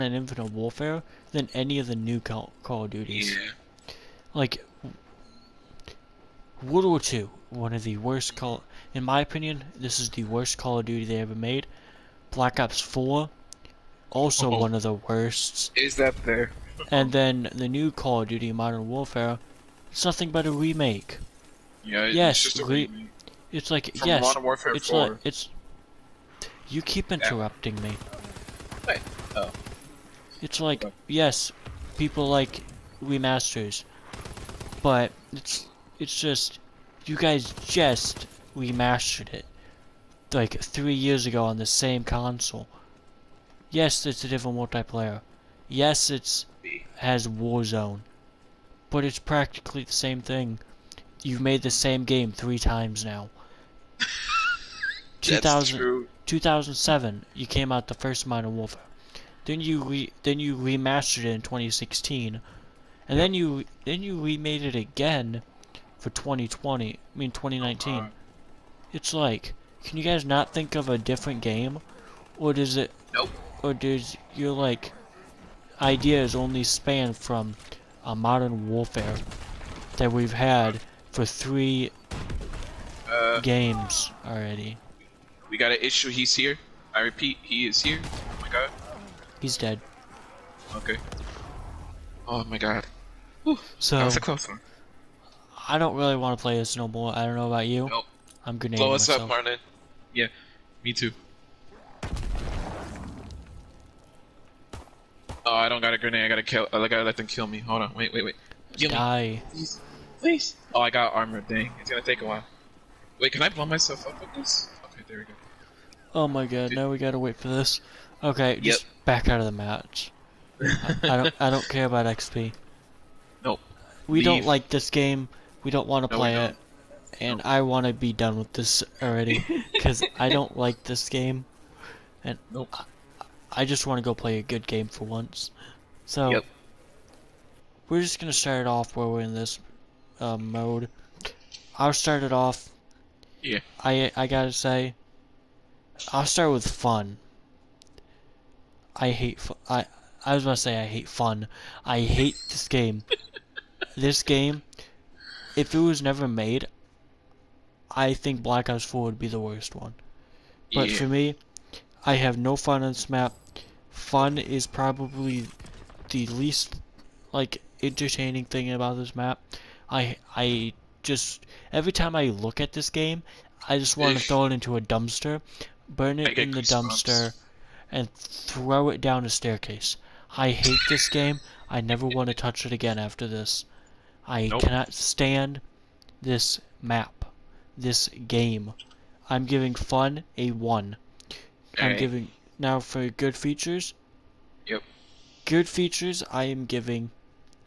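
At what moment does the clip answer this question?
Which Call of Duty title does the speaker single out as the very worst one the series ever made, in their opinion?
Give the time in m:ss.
0:06.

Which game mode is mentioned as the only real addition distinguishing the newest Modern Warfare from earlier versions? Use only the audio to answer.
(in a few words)
Warzone.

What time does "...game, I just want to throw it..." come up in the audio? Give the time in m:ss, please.
2:52.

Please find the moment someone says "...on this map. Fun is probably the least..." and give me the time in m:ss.
2:42.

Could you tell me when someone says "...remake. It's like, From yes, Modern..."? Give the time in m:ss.
0:22.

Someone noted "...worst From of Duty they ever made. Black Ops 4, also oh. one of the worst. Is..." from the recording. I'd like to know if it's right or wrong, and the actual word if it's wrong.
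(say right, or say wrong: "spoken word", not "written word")
wrong: "Call", not "From".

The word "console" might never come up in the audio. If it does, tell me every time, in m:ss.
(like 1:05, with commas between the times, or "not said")
0:42.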